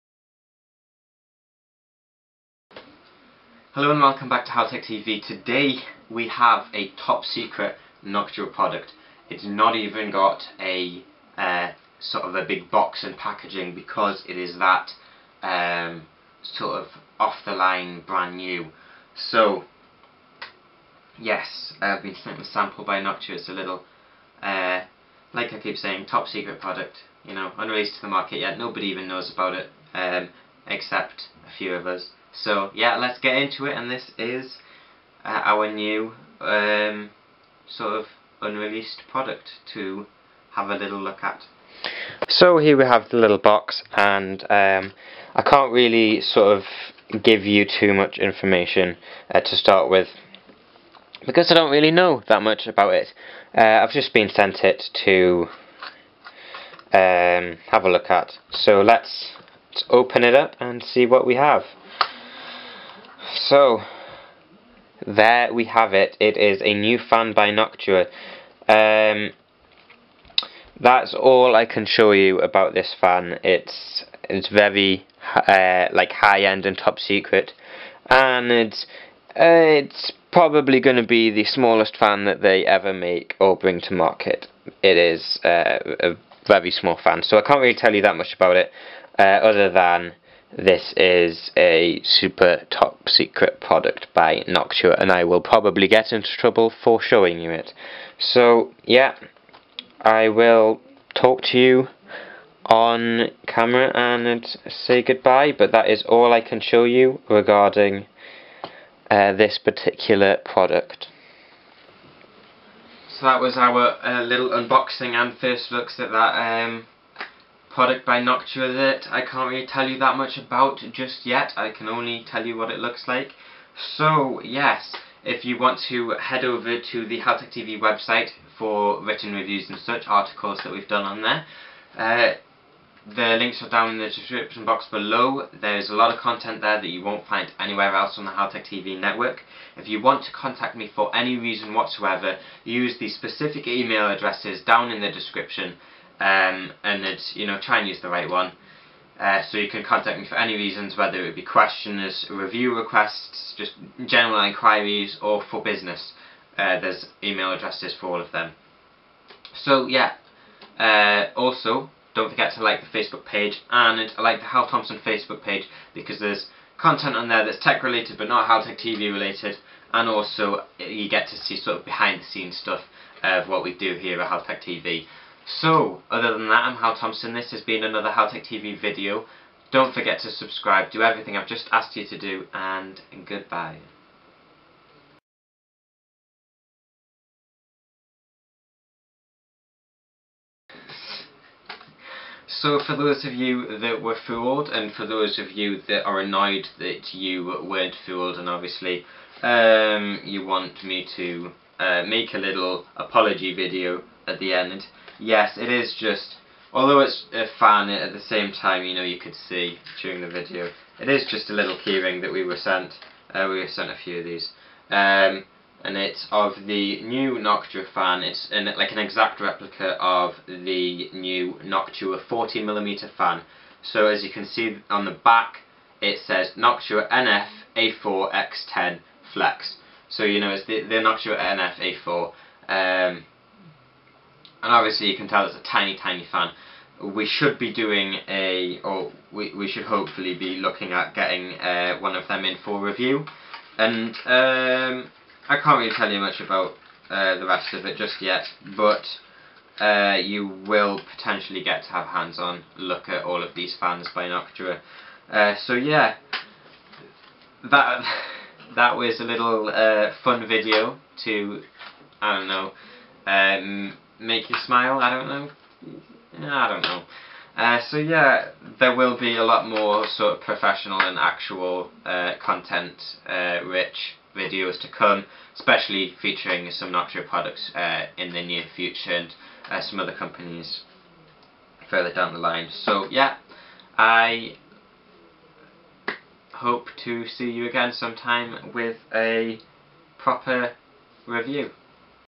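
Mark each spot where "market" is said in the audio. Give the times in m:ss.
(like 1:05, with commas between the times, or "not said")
0:28, 1:23.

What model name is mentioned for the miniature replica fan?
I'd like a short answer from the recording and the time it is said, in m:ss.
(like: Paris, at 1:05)
NF A4X10 Flex, at 3:47.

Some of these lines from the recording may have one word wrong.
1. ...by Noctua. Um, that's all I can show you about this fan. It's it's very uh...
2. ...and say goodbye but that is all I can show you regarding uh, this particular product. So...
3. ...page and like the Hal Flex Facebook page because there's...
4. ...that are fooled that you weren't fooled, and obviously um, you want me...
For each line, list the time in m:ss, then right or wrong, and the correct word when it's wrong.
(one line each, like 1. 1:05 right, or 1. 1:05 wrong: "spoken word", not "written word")
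1. 1:07 right
2. 1:43 right
3. 2:43 wrong: "Thompson", not "Flex"
4. 3:15 wrong: "annoyed", not "fooled".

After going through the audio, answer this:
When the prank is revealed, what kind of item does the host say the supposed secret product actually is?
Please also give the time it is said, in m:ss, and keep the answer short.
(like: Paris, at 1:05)
keyring, at 3:31.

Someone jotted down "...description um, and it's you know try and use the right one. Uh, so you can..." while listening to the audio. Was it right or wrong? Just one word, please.
right.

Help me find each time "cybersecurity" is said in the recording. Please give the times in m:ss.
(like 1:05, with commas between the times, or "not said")
not said.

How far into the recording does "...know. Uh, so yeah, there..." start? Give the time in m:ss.
4:26.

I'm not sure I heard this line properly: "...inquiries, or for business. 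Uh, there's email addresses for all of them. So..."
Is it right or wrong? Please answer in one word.
right.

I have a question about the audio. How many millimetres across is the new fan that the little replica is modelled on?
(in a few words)
40mm.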